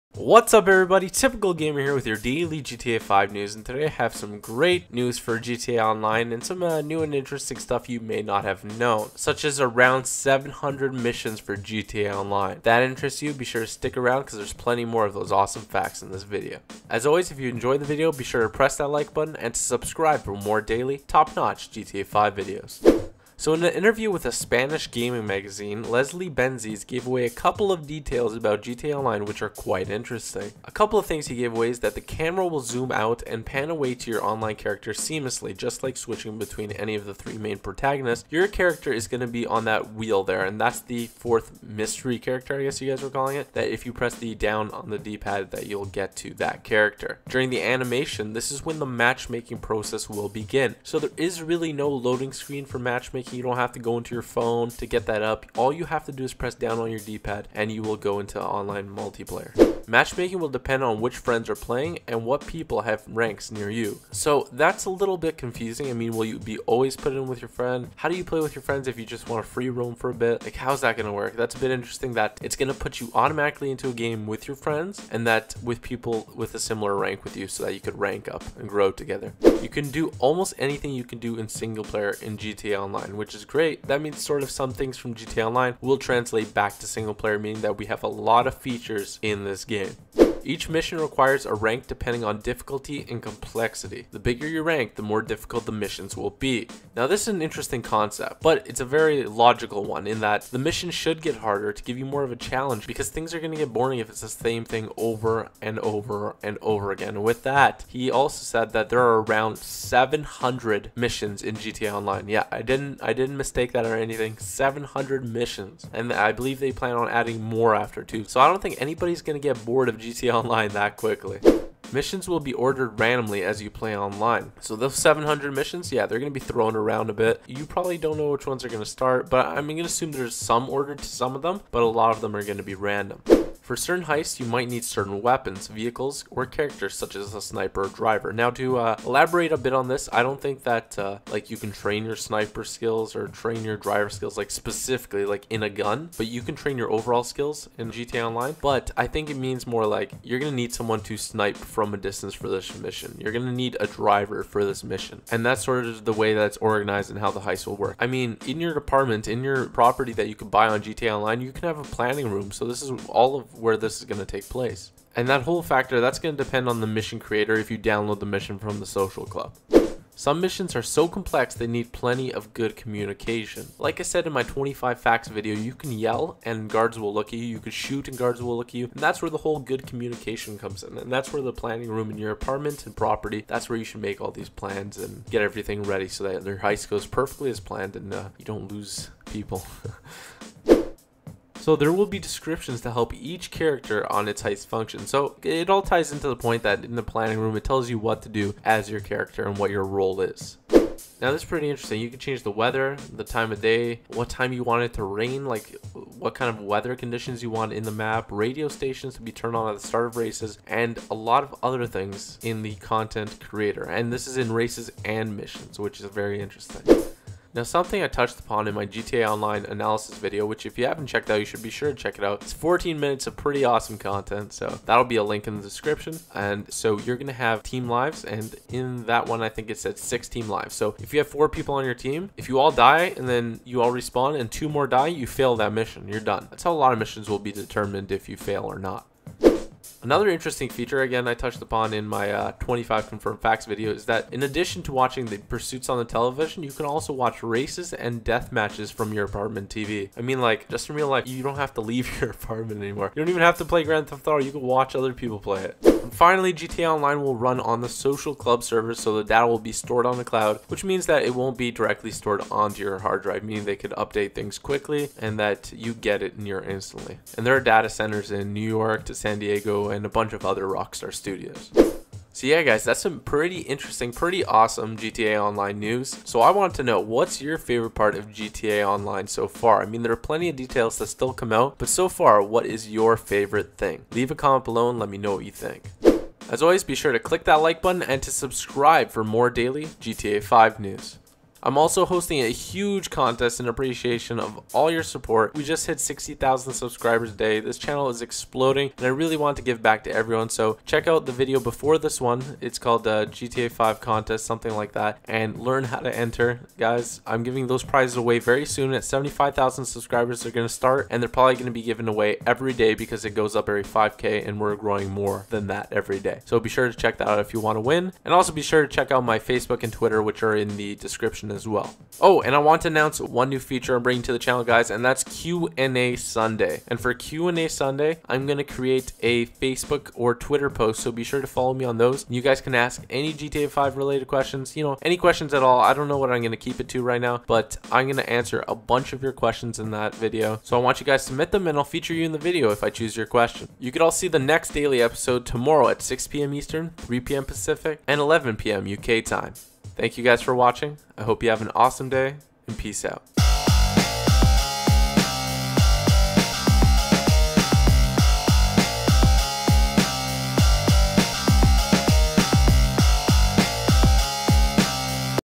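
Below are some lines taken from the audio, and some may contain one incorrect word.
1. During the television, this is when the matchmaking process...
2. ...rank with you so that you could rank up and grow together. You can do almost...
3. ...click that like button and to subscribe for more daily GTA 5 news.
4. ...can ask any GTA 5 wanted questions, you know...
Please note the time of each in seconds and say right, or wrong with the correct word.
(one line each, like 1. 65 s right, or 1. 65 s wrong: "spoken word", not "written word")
1. 47 s wrong: "animation", not "television"
2. 76 s right
3. 287 s right
4. 332 s wrong: "related", not "wanted".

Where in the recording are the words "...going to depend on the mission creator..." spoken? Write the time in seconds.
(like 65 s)
166 s.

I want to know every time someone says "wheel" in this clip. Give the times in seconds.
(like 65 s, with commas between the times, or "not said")
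39 s.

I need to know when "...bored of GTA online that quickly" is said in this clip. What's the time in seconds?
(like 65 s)
119 s.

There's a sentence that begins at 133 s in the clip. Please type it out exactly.
For certain heists, you might need certain weapons, vehicles, or characters such as a sniper or driver.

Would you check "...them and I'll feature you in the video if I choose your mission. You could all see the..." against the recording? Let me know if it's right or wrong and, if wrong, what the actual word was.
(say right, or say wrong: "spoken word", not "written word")
wrong: "question", not "mission".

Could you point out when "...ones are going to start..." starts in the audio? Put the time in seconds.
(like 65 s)
128 s.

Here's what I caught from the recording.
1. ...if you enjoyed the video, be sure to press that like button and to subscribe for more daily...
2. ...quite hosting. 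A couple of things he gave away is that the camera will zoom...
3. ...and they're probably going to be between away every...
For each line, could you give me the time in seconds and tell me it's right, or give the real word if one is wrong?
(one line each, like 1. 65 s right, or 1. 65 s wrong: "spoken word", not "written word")
1. 17 s right
2. 29 s wrong: "interesting", not "hosting"
3. 311 s wrong: "given", not "between".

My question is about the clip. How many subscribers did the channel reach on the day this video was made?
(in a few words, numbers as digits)
60,000.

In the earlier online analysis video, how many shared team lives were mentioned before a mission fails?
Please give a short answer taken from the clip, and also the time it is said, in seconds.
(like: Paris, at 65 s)
6, at 229 s.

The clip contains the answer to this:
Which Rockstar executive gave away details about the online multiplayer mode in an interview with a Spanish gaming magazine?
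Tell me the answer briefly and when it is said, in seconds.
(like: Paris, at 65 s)
Leslie Benzies, at 25 s.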